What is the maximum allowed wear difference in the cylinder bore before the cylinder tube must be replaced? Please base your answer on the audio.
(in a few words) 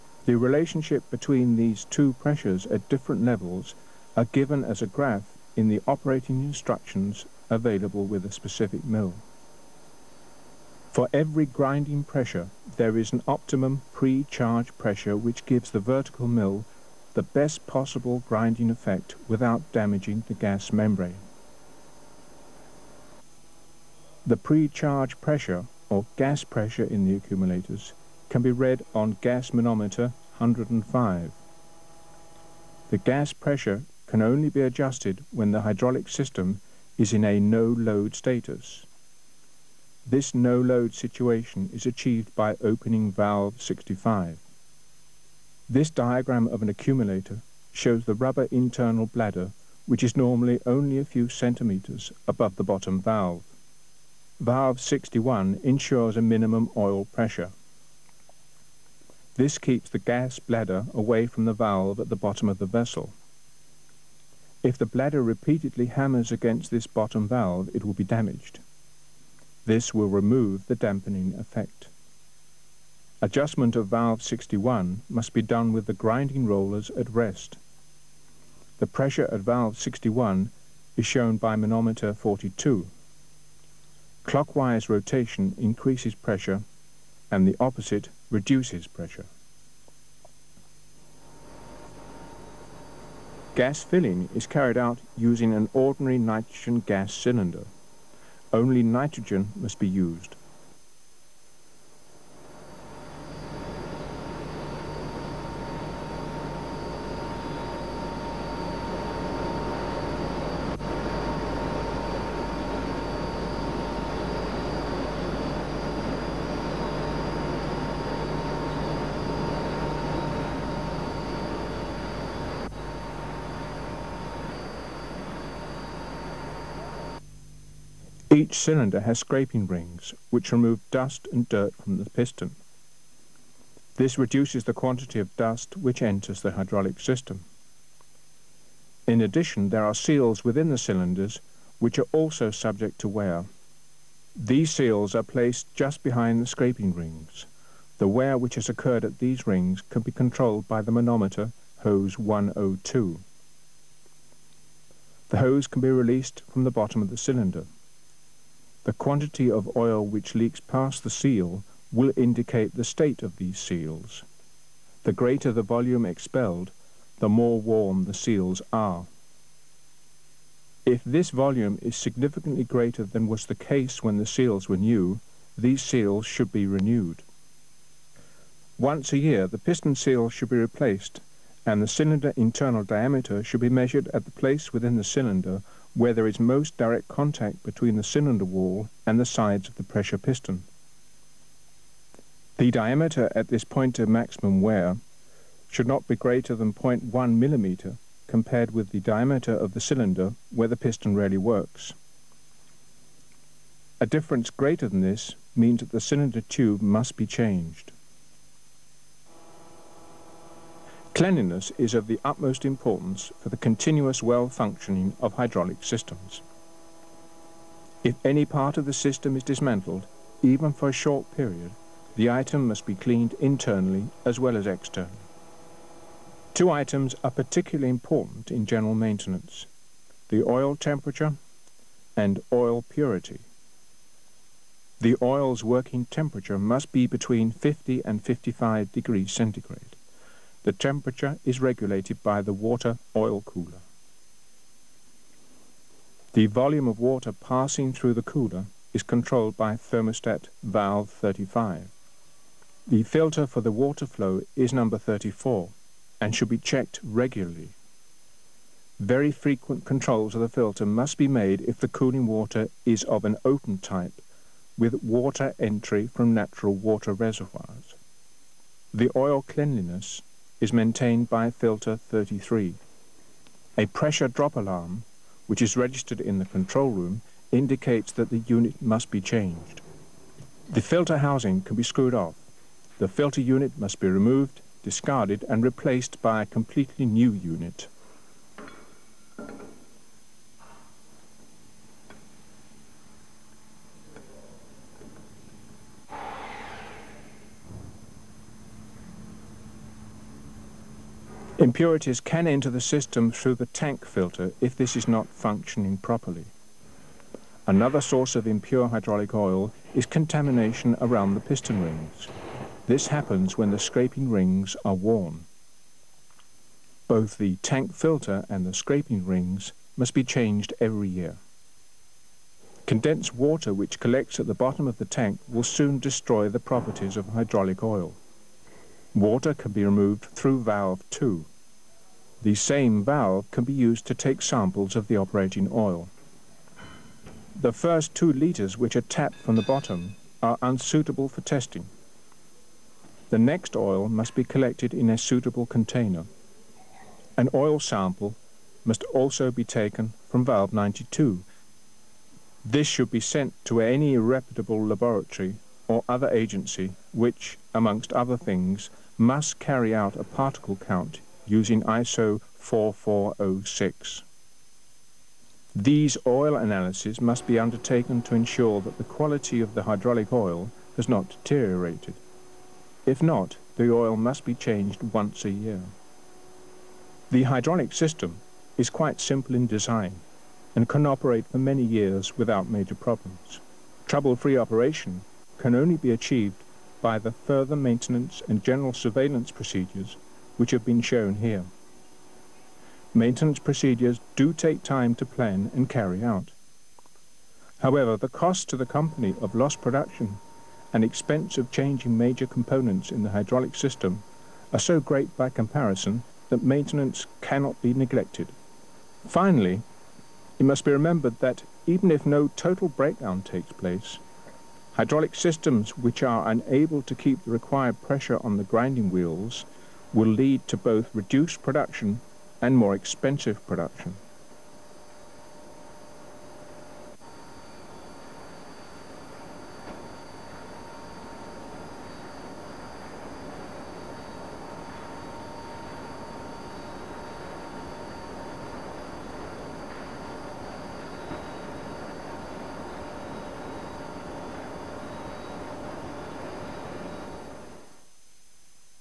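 0.1 mm.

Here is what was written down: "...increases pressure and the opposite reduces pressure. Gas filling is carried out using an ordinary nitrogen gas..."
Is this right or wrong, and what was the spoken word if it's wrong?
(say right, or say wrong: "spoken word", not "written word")
right.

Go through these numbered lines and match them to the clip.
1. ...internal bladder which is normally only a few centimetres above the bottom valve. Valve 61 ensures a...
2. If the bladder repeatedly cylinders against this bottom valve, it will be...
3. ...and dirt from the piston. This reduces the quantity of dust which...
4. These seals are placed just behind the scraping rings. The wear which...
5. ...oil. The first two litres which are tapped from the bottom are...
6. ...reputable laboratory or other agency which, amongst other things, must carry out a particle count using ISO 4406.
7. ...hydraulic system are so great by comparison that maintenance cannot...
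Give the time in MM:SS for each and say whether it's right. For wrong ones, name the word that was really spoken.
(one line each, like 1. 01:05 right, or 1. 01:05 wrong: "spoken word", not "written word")
1. 00:48 right
2. 01:04 wrong: "hammers", not "cylinders"
3. 02:11 right
4. 02:24 right
5. 05:35 right
6. 05:54 right
7. 06:43 right.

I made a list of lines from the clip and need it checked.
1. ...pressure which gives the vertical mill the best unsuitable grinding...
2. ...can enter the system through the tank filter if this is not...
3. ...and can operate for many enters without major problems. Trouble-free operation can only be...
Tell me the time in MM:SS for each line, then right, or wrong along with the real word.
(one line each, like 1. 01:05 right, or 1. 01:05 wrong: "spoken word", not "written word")
1. 00:14 wrong: "possible", not "unsuitable"
2. 05:02 right
3. 06:20 wrong: "years", not "enters".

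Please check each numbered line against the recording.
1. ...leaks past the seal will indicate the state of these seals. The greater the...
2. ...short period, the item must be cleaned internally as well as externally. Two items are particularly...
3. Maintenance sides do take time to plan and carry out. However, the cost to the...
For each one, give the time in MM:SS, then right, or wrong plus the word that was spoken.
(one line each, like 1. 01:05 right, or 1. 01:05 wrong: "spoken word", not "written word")
1. 02:40 right
2. 03:40 right
3. 06:33 wrong: "procedures", not "sides".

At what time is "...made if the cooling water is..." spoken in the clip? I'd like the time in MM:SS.
04:21.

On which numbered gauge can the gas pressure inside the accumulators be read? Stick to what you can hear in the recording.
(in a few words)
105.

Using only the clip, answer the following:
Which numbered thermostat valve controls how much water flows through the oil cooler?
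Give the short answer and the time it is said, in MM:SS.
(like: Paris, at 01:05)
35, at 04:09.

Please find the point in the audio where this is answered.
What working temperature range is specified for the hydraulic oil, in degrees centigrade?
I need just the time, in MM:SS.
03:57.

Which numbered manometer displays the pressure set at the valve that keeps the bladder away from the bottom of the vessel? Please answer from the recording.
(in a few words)
42.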